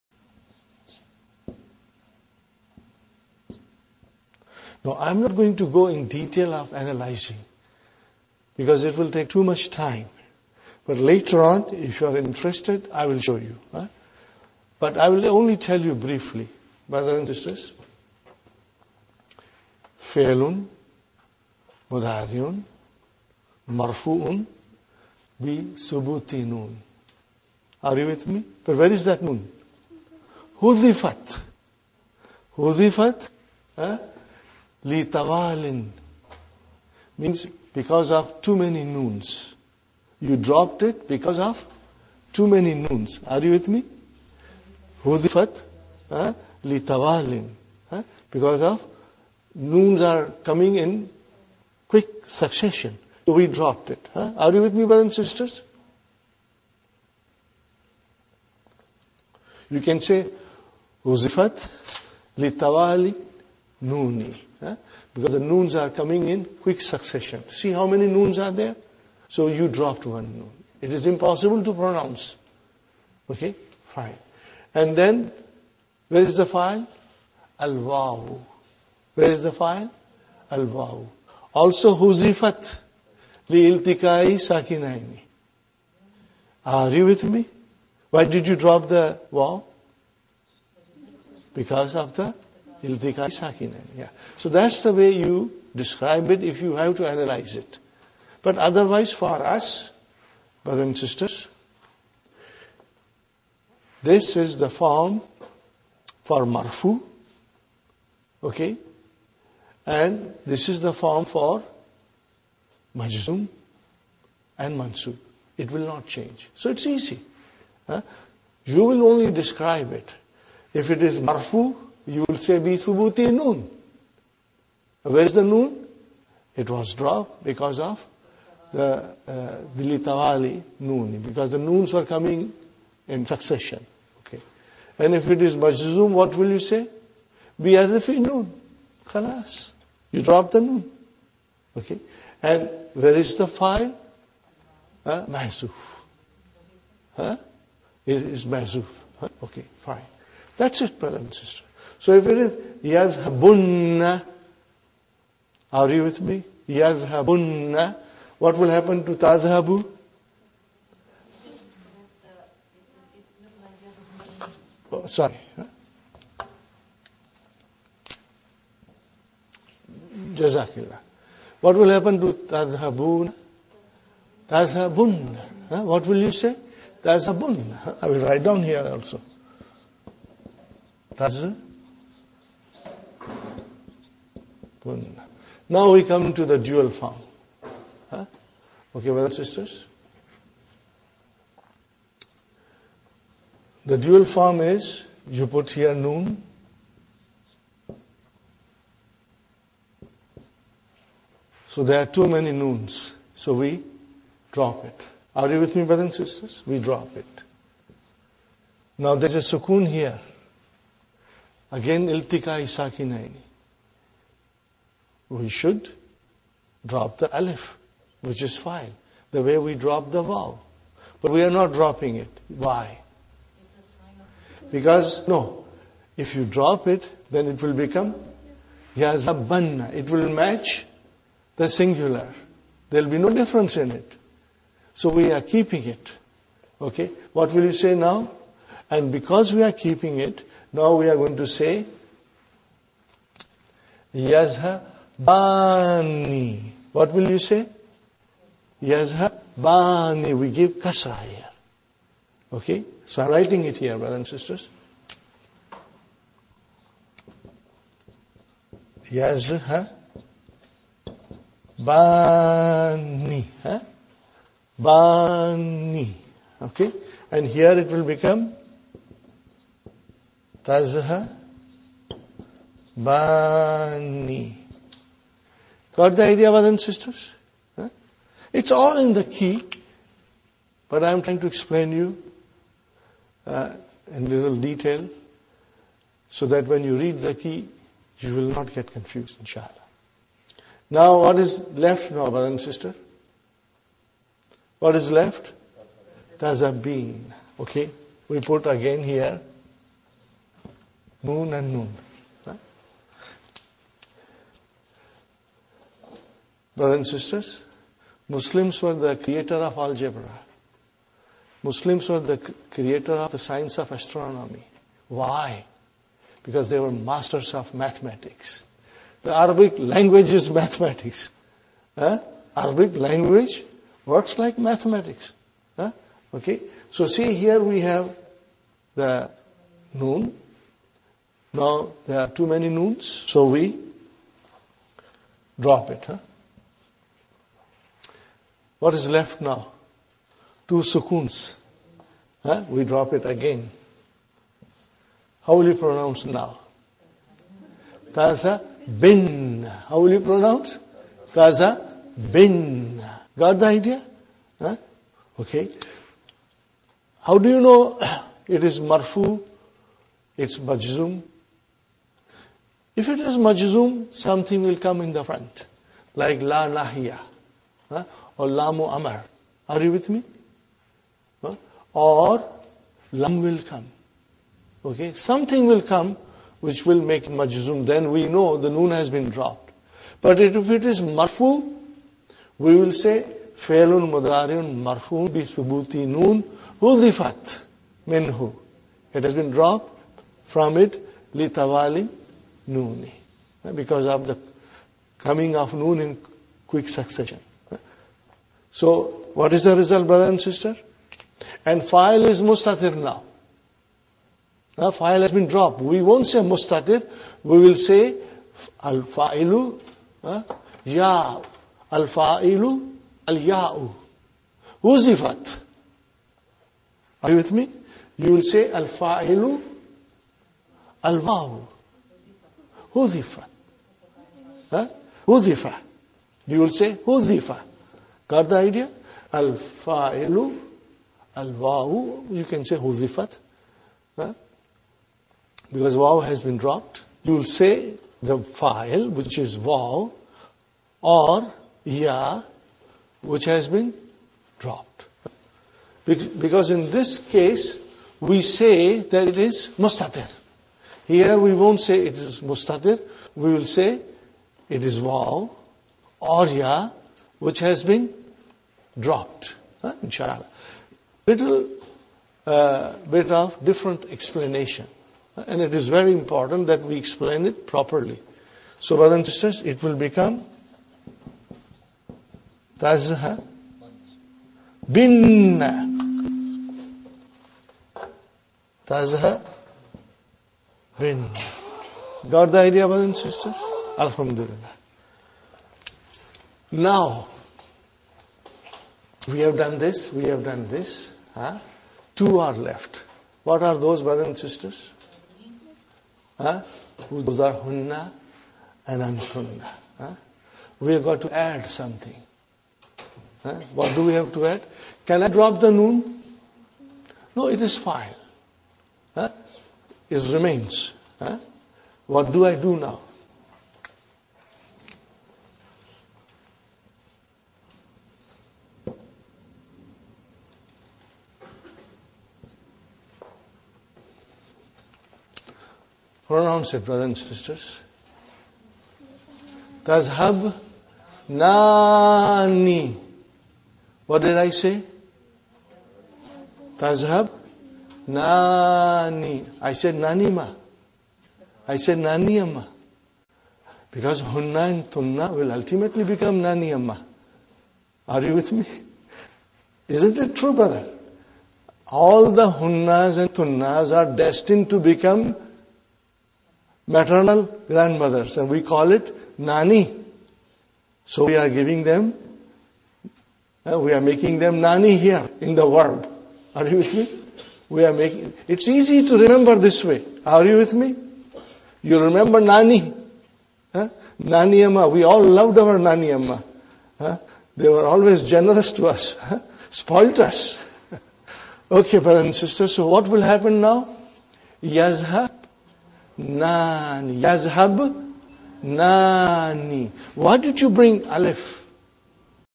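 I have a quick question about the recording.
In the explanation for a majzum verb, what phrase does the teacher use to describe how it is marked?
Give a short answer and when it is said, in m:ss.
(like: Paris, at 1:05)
Bi hadfi noon, at 2:17.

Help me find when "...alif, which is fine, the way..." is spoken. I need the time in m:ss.
3:37.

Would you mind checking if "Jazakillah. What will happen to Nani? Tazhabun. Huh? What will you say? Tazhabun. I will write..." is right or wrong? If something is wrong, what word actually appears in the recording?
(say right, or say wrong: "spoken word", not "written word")
wrong: "Tazhabun", not "Nani".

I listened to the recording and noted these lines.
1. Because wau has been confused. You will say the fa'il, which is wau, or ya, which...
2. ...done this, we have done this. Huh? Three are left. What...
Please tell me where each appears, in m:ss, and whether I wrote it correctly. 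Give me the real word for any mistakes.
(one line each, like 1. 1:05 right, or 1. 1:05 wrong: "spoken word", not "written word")
1. 7:15 wrong: "dropped", not "confused"
2. 8:09 wrong: "Two", not "Three".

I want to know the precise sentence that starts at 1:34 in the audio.
So that's the way you describe it if you have to analyze it.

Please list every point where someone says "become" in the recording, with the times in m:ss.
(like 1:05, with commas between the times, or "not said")
3:47, 4:28, 7:49, 9:06, 9:14.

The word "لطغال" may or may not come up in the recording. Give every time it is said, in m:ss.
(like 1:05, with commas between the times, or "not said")
0:34, 0:46.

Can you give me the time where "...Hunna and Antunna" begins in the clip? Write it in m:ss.
8:17.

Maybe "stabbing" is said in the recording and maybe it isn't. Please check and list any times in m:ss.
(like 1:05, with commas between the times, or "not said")
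not said.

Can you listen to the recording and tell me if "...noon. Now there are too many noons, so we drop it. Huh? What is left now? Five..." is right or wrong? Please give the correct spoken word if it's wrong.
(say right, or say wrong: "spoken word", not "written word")
wrong: "Two", not "Five".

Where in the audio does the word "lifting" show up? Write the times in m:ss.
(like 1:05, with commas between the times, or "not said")
not said.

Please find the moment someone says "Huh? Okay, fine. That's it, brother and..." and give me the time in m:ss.
2:29.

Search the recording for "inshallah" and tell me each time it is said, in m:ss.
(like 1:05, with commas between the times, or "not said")
4:49, 7:40.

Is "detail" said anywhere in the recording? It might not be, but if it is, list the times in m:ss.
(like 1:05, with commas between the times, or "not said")
0:06, 4:44.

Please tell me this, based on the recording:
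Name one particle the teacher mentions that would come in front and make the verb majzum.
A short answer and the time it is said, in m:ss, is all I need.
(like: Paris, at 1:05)
la nahiya, at 6:06.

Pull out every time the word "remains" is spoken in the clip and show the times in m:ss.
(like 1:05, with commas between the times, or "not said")
8:30.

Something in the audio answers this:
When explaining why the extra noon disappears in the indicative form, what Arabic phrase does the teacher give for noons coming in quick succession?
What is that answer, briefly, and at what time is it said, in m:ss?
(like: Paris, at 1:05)
litawali nuni, at 1:01.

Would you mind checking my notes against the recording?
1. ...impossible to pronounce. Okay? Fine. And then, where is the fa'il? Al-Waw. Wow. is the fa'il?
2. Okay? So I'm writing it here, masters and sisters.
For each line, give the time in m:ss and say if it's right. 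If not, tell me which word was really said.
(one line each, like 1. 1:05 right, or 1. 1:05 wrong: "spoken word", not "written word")
1. 1:11 right
2. 4:12 wrong: "brothers", not "masters".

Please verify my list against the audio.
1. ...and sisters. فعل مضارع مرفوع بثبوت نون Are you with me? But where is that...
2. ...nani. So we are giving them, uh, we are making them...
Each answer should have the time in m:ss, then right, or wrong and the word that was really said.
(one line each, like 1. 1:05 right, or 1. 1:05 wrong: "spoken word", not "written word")
1. 0:17 right
2. 9:19 right.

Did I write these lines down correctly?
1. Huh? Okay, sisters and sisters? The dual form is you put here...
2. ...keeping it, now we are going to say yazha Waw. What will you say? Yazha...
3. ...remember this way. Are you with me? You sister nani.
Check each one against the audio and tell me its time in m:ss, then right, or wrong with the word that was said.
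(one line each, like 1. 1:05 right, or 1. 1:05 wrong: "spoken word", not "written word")
1. 3:08 wrong: "brothers", not "sisters"
2. 3:59 wrong: "Bani", not "Waw"
3. 9:29 wrong: "remember", not "sister".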